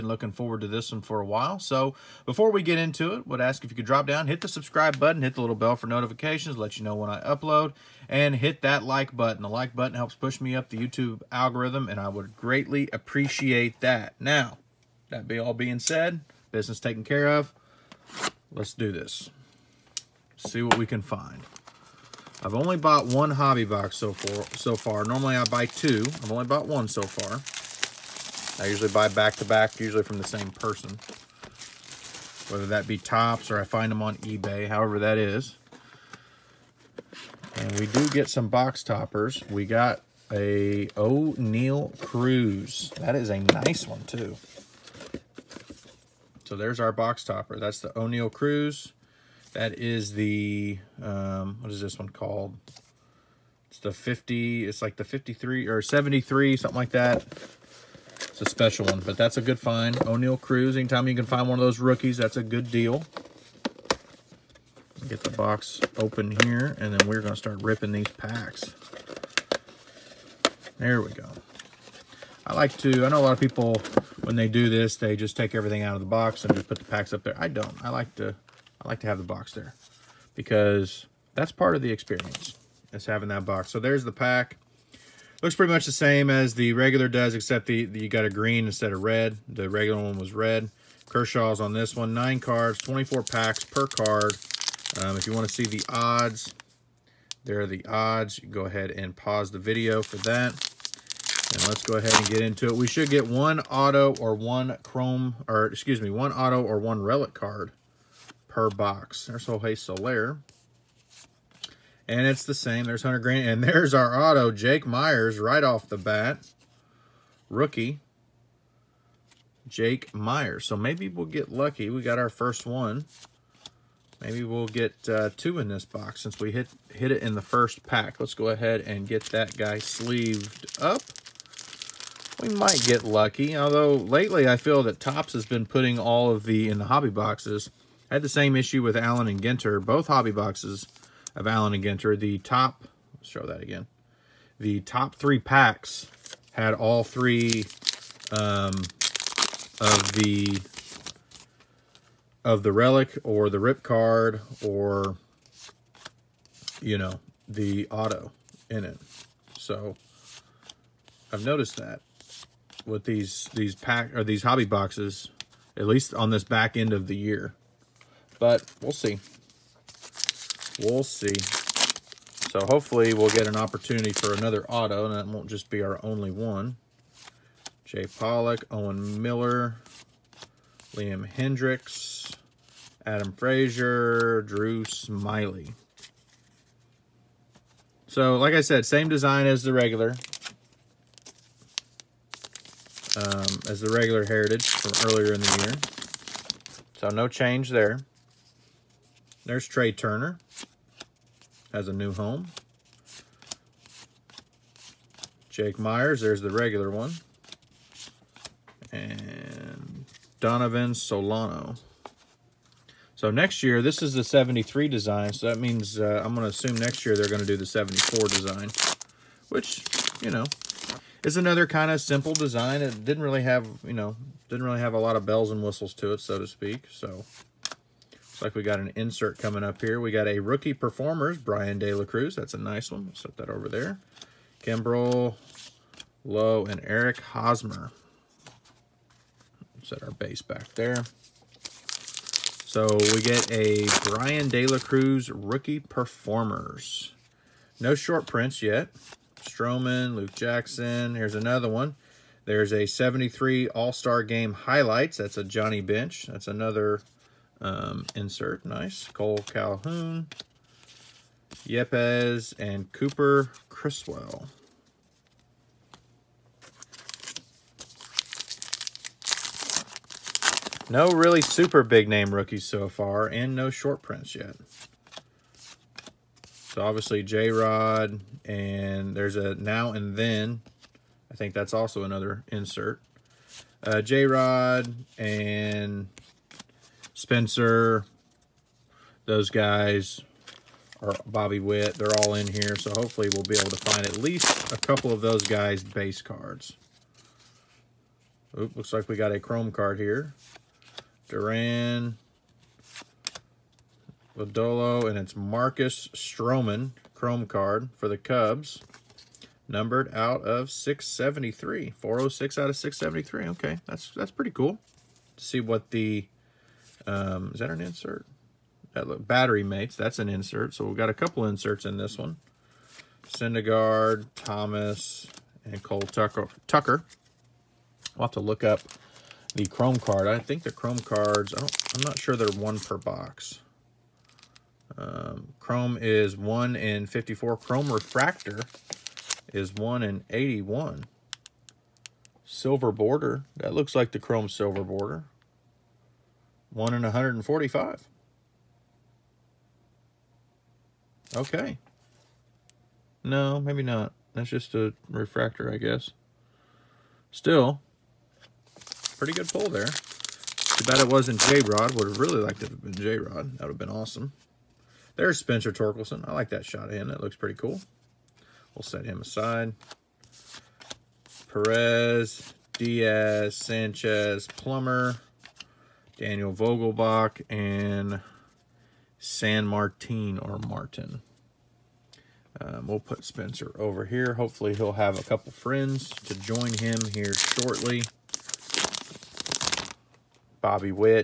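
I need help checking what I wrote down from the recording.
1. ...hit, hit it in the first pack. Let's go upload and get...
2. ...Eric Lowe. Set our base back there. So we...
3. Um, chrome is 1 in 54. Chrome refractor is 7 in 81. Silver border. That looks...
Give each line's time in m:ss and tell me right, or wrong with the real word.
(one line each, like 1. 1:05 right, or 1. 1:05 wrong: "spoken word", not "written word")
1. 2:06 wrong: "ahead", not "upload"
2. 3:56 wrong: "Hosmer", not "Lowe"
3. 5:34 wrong: "1", not "7".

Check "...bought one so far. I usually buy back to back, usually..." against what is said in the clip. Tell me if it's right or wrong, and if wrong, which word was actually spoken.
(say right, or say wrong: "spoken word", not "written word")
right.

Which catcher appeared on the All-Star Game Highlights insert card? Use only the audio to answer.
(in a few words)
Johnny Bench.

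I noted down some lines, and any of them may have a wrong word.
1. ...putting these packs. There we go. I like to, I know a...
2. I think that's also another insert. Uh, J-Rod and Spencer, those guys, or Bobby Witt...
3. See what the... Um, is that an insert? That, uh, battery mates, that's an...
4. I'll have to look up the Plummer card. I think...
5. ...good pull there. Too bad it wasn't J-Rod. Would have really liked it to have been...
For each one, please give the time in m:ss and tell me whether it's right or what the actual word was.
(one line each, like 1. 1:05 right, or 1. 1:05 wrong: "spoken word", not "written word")
1. 1:07 wrong: "ripping", not "putting"
2. 4:41 right
3. 5:15 right
4. 5:28 wrong: "Chrome", not "Plummer"
5. 5:59 right.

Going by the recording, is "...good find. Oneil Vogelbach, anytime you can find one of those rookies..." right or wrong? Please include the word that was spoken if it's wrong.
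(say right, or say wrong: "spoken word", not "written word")
wrong: "Cruz", not "Vogelbach".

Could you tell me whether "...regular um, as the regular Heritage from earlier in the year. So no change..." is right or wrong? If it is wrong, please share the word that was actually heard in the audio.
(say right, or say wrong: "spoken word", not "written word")
right.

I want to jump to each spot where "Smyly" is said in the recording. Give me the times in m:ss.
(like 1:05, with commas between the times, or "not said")
3:04.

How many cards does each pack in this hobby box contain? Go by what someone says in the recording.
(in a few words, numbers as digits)
9.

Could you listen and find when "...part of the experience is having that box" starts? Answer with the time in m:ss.
1:21.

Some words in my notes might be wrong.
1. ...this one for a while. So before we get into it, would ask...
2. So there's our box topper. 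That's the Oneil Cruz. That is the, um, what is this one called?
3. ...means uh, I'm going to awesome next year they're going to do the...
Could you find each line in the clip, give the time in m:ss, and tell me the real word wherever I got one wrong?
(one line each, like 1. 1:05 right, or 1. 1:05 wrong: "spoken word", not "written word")
1. 0:00 right
2. 0:46 right
3. 3:35 wrong: "assume", not "awesome".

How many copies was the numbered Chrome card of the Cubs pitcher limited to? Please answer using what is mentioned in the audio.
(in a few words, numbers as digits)
673.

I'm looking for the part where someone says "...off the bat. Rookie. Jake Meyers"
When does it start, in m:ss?
1:55.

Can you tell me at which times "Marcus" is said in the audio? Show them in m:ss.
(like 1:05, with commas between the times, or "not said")
5:05.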